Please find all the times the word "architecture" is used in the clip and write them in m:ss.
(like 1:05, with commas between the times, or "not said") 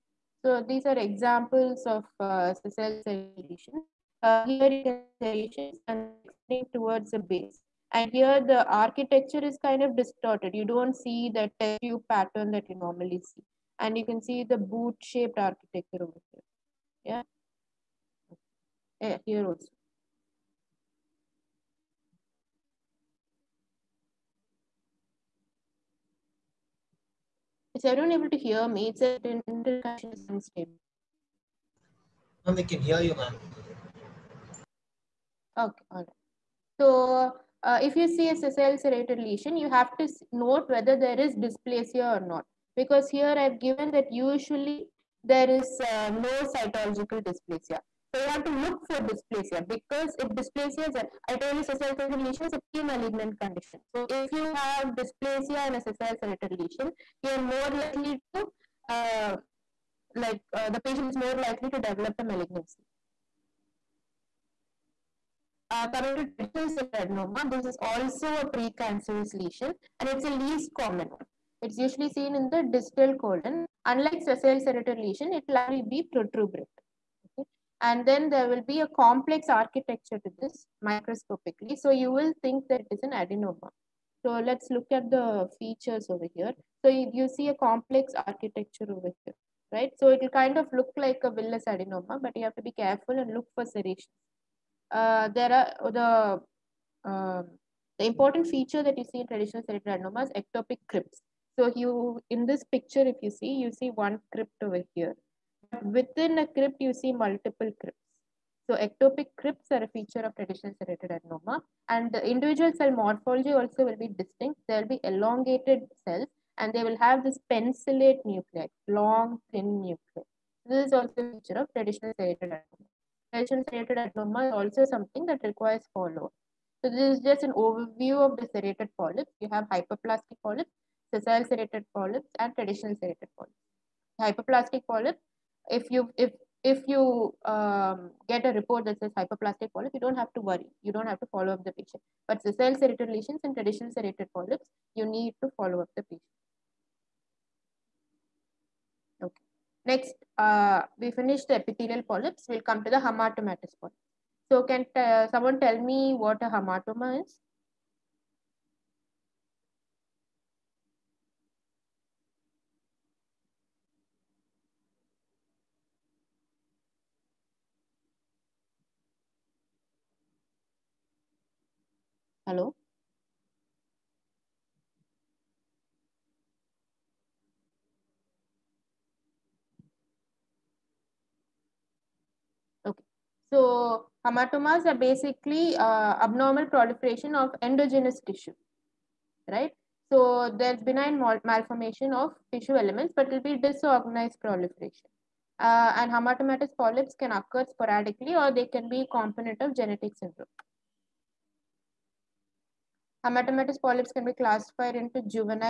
0:08, 0:15, 1:19, 1:28.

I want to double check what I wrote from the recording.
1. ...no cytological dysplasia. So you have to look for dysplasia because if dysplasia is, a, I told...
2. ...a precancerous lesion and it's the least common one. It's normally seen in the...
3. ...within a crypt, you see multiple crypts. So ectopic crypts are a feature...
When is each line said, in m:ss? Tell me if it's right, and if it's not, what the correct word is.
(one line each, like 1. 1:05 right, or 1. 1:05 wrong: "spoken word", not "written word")
1. 0:46 right
2. 1:08 wrong: "usually", not "normally"
3. 1:45 right.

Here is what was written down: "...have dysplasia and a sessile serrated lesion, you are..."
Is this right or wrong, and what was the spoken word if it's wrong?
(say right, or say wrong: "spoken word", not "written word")
right.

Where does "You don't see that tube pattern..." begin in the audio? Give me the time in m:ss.
0:10.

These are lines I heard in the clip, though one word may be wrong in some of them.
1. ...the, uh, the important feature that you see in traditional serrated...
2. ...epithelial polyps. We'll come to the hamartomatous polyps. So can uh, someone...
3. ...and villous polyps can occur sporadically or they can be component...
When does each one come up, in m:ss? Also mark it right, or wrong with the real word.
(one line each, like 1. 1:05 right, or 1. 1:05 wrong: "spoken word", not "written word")
1. 1:35 right
2. 2:31 right
3. 3:15 wrong: "hamartomatous", not "villous".